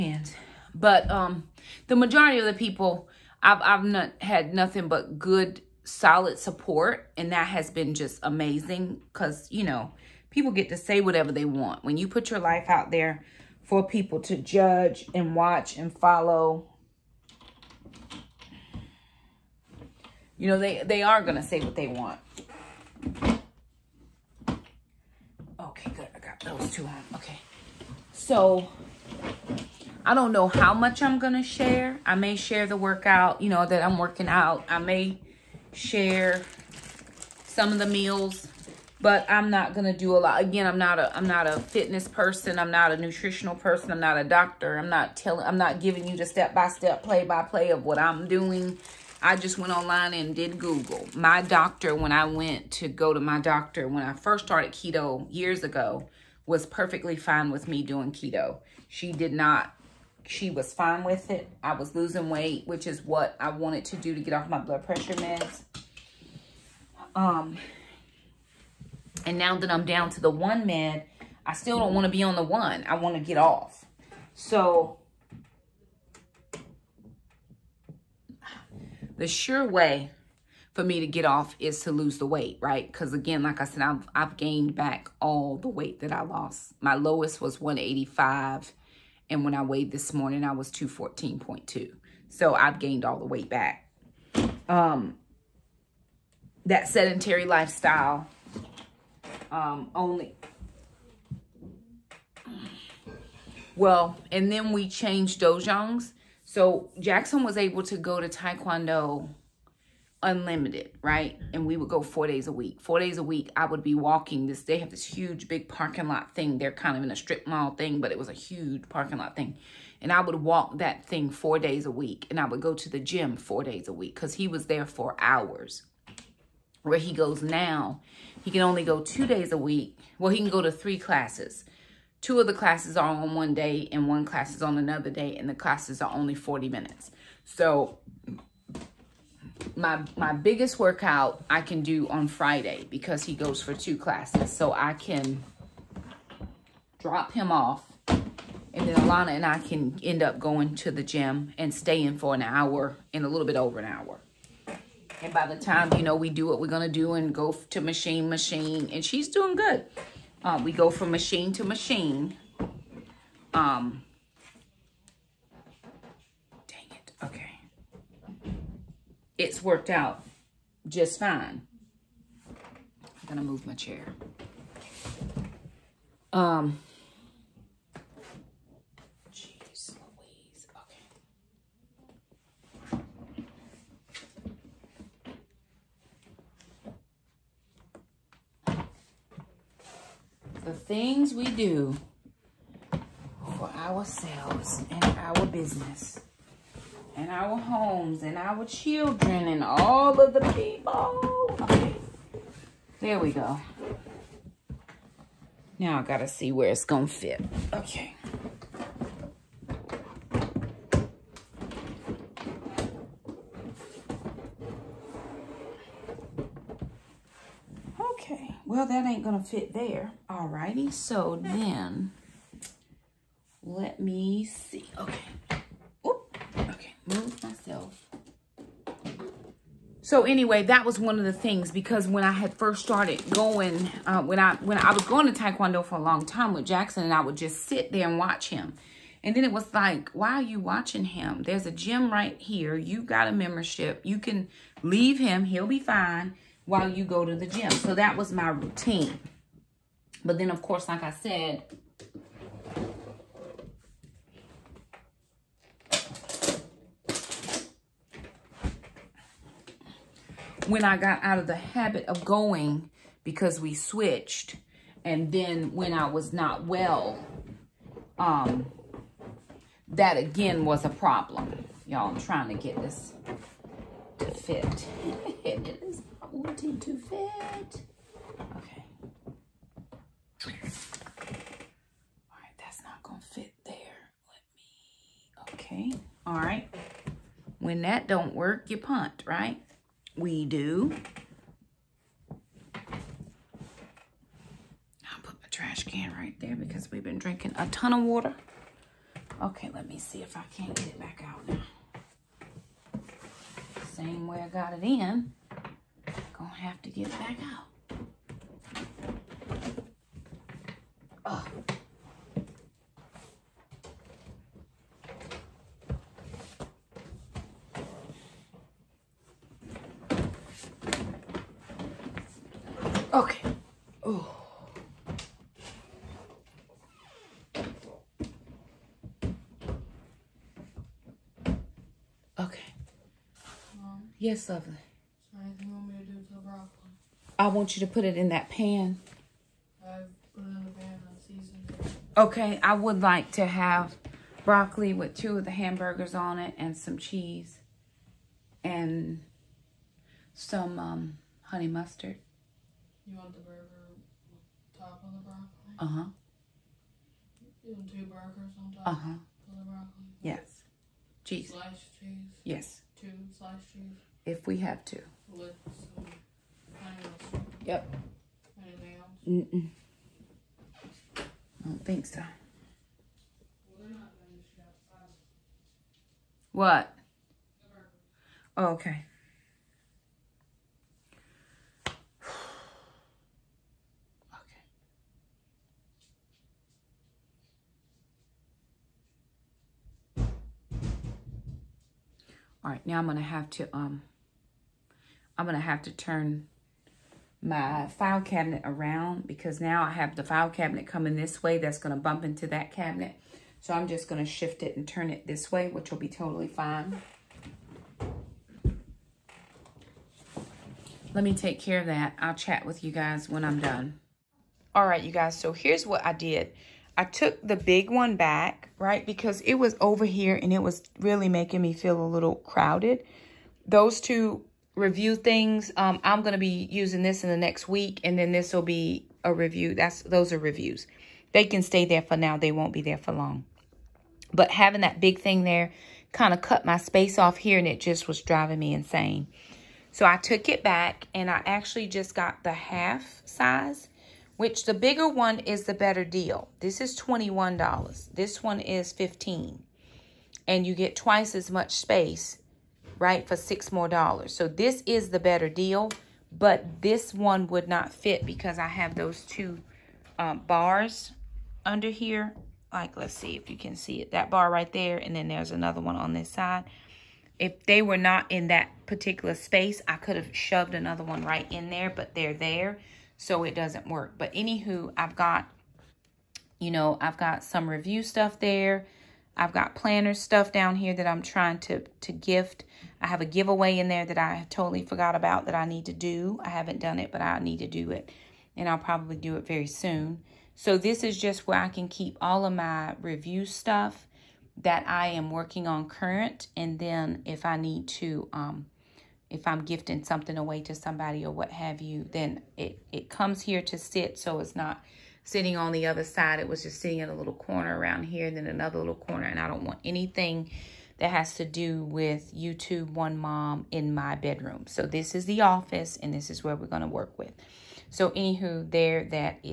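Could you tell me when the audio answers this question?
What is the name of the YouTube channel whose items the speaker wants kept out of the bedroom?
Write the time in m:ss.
8:32.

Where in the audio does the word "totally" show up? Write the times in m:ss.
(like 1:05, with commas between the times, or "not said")
6:46, 8:04.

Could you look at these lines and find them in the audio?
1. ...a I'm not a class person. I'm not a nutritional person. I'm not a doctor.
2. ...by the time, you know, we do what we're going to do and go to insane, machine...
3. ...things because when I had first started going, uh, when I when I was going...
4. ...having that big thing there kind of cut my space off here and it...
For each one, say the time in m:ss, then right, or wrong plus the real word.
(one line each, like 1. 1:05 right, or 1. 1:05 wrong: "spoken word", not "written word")
1. 0:40 wrong: "fitness", not "class"
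2. 2:35 wrong: "machine", not "insane"
3. 3:51 right
4. 7:14 right.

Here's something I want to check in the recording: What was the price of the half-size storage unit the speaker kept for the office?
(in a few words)
$15.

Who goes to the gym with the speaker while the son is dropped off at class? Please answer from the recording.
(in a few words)
Alana.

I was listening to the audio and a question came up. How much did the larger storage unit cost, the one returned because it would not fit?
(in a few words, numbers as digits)
$21.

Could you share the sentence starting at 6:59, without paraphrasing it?
Because it was over here and it was really making me feel a little crowded.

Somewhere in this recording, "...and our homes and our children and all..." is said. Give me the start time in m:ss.
3:17.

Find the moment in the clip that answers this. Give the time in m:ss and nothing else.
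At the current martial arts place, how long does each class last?
2:16.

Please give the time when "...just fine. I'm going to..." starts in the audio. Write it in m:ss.
2:50.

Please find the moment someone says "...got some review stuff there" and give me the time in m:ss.
7:57.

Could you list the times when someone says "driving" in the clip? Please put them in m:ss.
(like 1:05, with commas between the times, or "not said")
7:18.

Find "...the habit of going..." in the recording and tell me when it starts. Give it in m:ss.
4:21.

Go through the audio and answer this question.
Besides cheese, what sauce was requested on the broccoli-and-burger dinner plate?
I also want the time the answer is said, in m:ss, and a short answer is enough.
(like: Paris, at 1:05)
honey mustard, at 5:51.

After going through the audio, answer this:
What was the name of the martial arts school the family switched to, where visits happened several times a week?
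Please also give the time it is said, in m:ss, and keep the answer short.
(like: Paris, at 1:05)
Taekwondo Unlimited, at 1:48.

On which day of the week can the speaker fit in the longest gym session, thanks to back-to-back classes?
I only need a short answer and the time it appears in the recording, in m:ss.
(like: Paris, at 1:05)
Friday, at 2:22.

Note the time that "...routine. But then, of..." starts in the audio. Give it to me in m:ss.
4:08.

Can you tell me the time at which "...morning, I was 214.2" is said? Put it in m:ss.
1:30.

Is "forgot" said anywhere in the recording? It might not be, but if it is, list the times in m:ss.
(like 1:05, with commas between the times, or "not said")
8:04.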